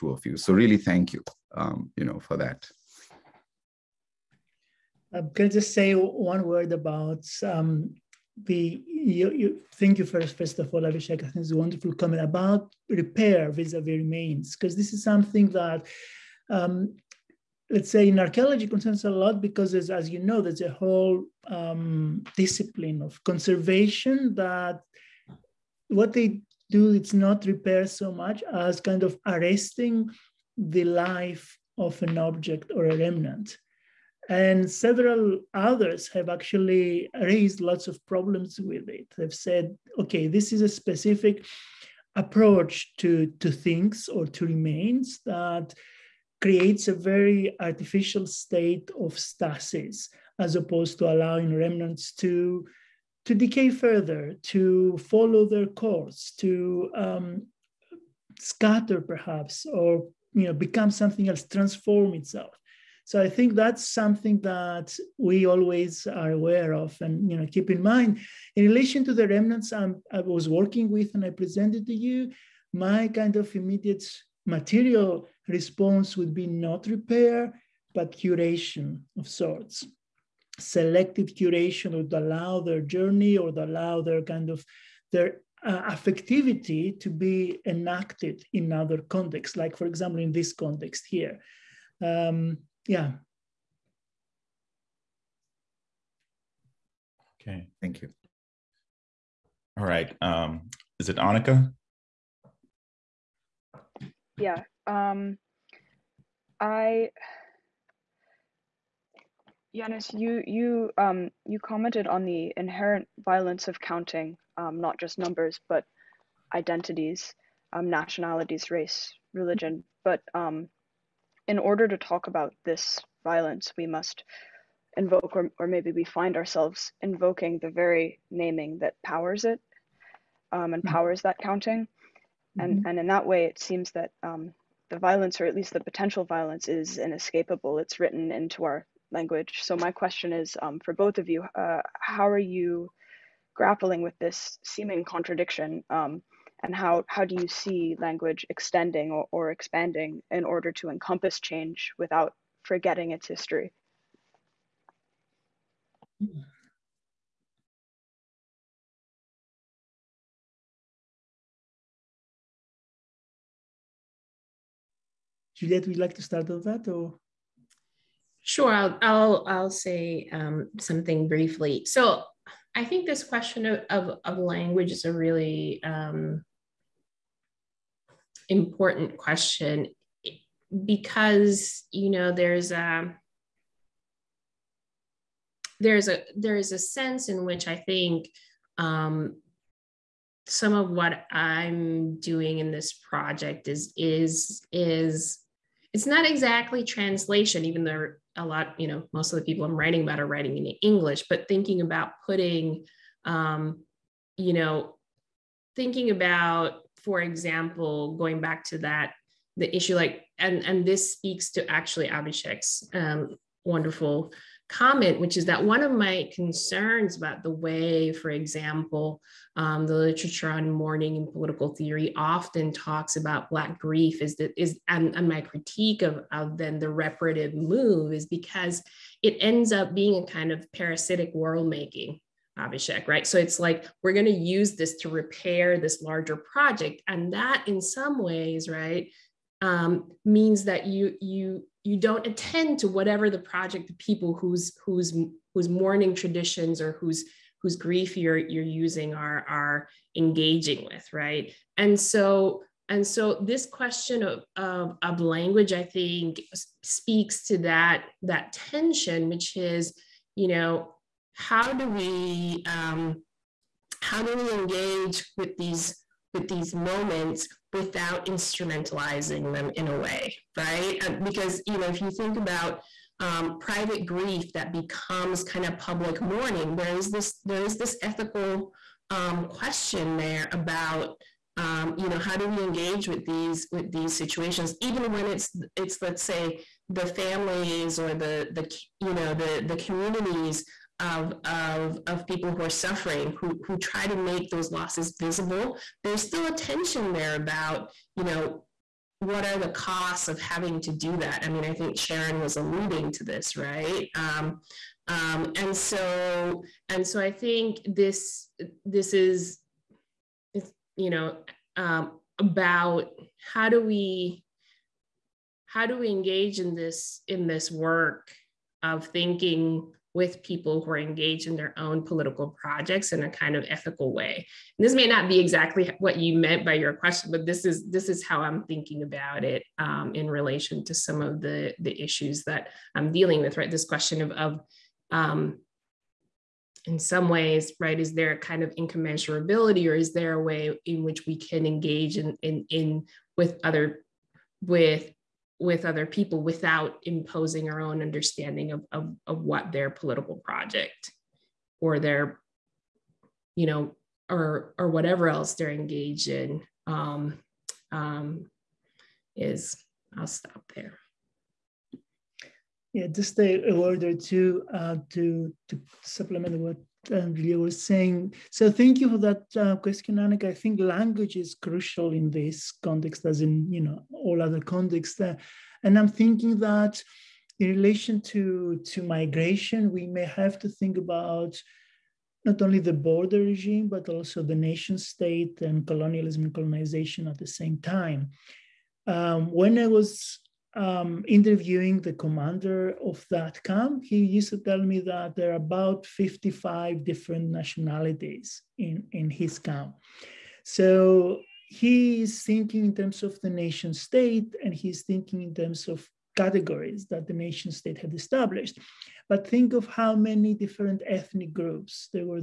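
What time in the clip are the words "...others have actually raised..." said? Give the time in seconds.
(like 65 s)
35 s.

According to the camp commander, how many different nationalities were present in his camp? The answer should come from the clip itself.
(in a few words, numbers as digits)
55.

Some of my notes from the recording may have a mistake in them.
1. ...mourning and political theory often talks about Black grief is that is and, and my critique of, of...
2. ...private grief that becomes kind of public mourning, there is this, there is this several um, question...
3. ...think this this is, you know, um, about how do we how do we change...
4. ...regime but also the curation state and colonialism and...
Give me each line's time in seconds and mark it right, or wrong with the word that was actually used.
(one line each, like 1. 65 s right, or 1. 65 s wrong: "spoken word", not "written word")
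1. 220 s right
2. 273 s wrong: "ethical", not "several"
3. 307 s wrong: "engage", not "change"
4. 383 s wrong: "nation", not "curation".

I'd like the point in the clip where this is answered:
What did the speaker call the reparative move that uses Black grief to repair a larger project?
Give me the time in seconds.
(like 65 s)
230 s.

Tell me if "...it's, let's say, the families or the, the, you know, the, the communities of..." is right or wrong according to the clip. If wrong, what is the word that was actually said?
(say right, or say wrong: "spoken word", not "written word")
right.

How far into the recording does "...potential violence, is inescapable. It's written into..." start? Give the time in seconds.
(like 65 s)
135 s.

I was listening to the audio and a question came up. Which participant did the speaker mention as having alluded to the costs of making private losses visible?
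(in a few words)
Sharon.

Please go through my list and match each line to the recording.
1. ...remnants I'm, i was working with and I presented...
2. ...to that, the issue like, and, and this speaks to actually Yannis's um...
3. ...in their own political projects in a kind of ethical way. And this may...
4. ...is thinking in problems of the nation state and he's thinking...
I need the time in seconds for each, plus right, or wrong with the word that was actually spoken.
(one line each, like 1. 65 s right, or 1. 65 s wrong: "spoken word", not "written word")
1. 69 s right
2. 208 s wrong: "Avishek", not "Yannis"
3. 321 s right
4. 402 s wrong: "terms", not "problems".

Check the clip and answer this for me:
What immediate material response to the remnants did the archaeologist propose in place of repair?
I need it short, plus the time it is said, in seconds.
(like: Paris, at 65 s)
Selective curation, at 80 s.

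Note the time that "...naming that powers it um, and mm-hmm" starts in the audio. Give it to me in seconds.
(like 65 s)
128 s.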